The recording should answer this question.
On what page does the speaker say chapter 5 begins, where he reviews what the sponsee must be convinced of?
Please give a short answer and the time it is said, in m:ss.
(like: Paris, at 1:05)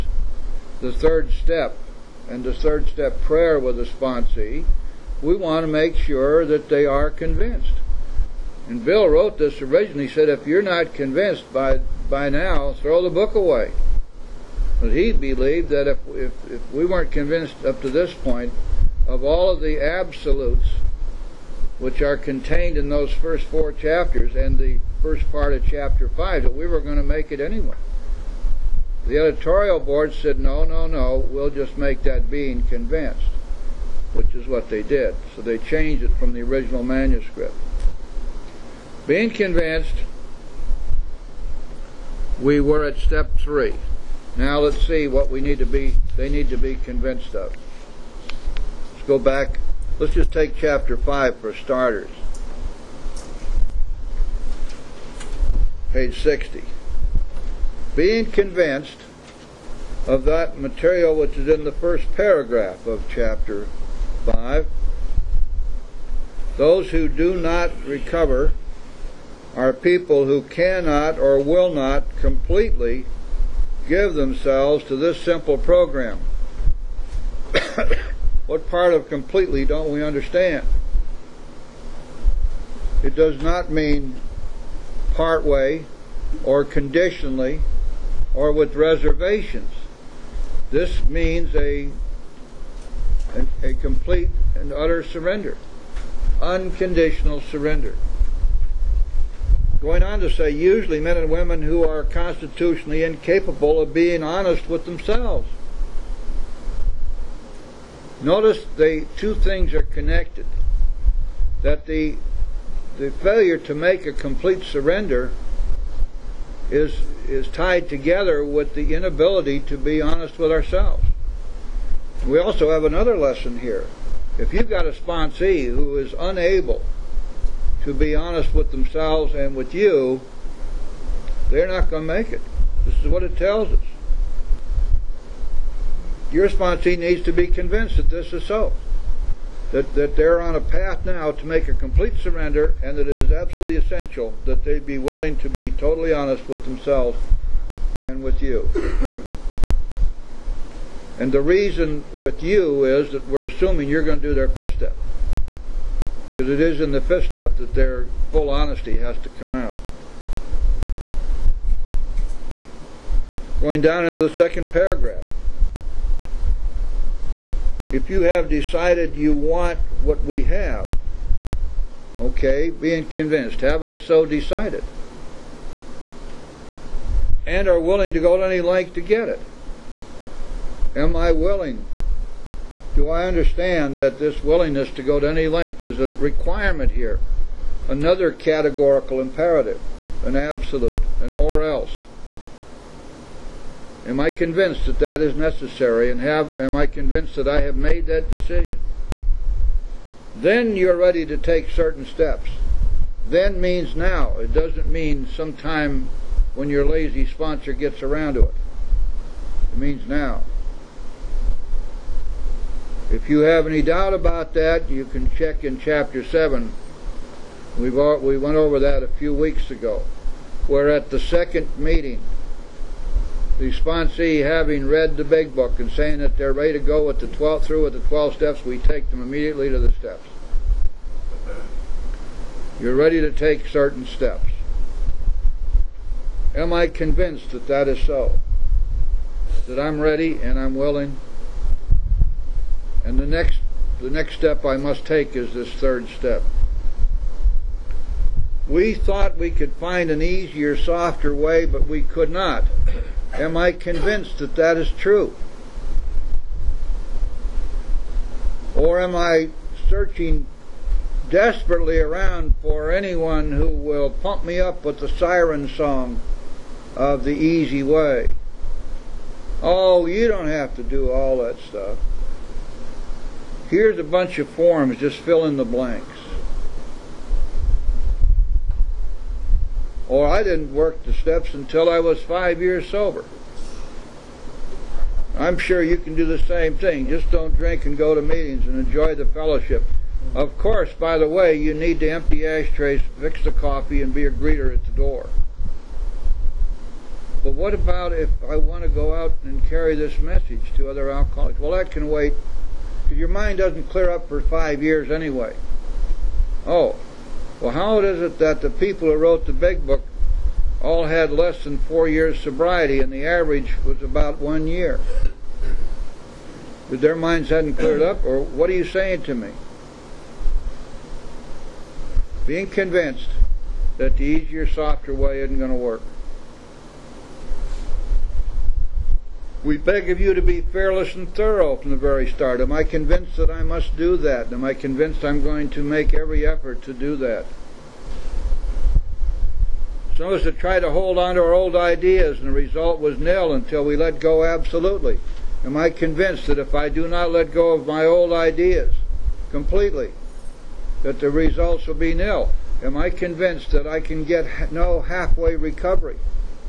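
60, at 0:55.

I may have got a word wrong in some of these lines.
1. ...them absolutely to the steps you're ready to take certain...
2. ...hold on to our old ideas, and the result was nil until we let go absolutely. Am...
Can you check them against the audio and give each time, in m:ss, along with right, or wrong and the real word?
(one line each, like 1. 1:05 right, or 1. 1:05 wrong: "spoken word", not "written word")
1. 3:49 wrong: "immediately", not "absolutely"
2. 5:40 right.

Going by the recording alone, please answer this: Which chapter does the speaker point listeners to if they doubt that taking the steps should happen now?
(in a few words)
Chapter 7.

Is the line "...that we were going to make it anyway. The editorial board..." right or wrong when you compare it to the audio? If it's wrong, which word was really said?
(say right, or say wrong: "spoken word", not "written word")
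right.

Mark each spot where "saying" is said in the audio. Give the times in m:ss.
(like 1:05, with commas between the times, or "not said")
3:45, 5:18.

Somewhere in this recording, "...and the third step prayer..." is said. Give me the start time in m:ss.
0:02.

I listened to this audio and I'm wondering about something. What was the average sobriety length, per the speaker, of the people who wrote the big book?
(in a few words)
About one year.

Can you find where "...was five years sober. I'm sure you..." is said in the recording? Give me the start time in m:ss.
4:41.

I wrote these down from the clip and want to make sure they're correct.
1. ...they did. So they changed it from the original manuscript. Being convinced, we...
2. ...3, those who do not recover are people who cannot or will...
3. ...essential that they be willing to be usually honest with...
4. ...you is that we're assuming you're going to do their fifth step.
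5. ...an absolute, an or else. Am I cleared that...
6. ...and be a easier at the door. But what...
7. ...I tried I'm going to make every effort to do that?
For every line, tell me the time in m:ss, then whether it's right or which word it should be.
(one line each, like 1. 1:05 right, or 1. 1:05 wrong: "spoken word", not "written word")
1. 0:34 right
2. 1:04 wrong: "5", not "3"
3. 2:23 wrong: "totally", not "usually"
4. 2:32 right
5. 3:10 wrong: "convinced", not "cleared"
6. 4:54 wrong: "greeter", not "easier"
7. 5:34 wrong: "convinced", not "tried".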